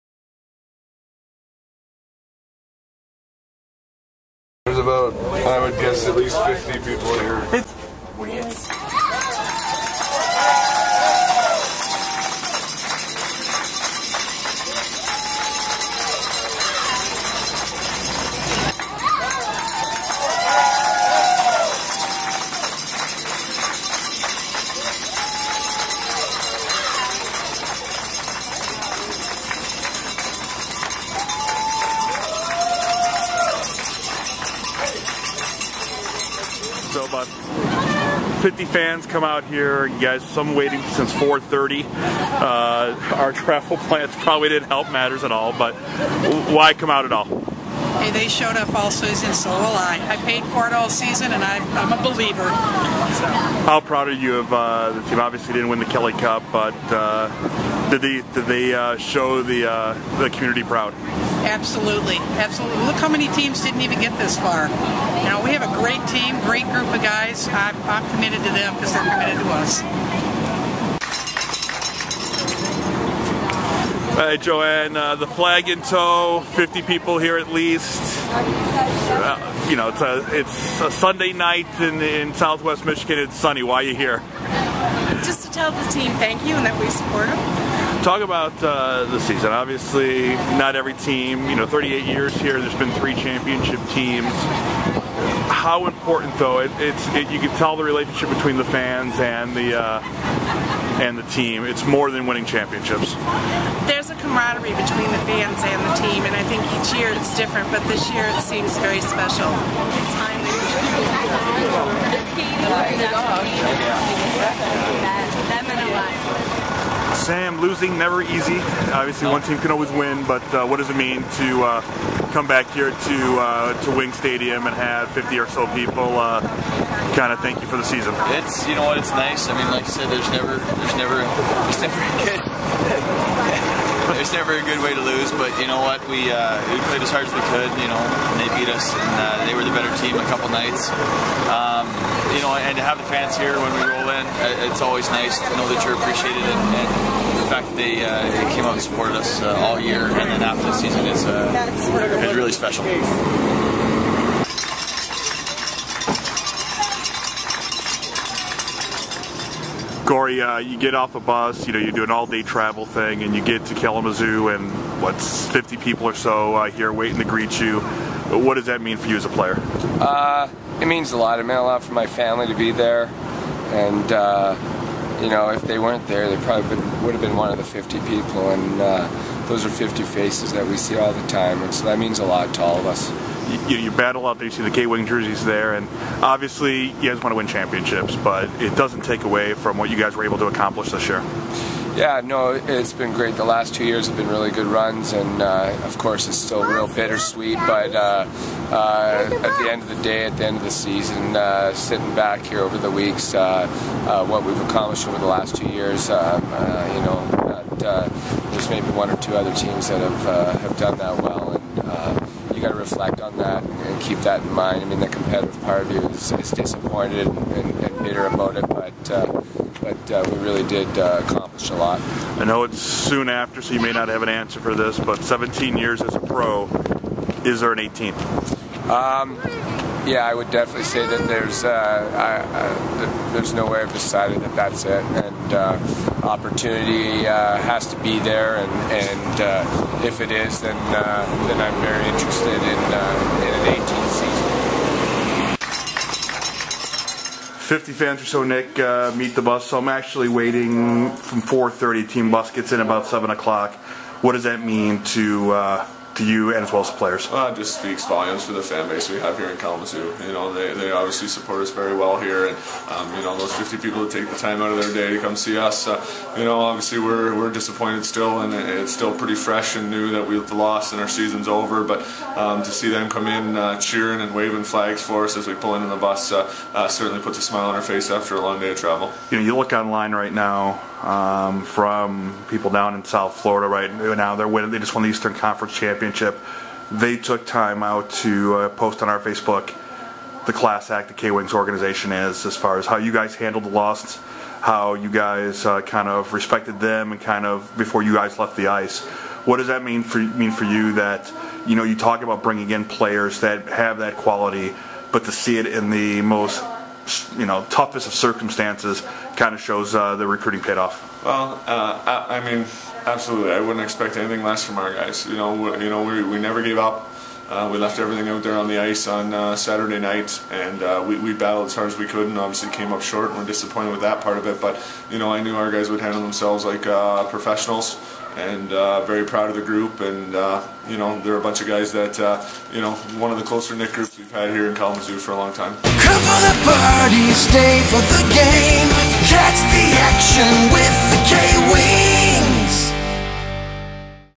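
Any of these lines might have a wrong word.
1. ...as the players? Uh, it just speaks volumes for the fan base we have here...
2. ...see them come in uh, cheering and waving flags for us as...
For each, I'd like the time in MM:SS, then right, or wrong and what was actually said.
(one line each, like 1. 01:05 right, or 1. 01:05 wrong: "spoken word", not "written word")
1. 04:16 right
2. 04:32 right.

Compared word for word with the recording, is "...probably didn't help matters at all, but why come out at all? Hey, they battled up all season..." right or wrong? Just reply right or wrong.
wrong.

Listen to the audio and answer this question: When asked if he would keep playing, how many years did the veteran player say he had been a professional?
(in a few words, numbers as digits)
17.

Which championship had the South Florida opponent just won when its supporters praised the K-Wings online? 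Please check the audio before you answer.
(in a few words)
Eastern Conference Championship.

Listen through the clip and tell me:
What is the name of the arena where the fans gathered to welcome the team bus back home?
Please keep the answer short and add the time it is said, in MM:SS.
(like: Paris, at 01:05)
Wing Stadium, at 02:03.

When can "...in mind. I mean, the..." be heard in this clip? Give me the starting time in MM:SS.
03:34.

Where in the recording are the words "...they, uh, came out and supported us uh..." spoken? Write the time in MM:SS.
02:27.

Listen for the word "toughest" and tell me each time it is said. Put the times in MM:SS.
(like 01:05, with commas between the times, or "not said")
05:07.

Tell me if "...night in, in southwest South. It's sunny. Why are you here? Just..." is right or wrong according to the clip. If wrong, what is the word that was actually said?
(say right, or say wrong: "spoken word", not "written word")
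wrong: "Michigan", not "South".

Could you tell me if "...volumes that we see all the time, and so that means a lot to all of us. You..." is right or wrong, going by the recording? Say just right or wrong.
wrong.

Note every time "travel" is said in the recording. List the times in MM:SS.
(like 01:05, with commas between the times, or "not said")
00:43, 02:42, 04:38.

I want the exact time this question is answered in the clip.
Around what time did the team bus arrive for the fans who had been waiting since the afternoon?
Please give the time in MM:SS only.
04:13.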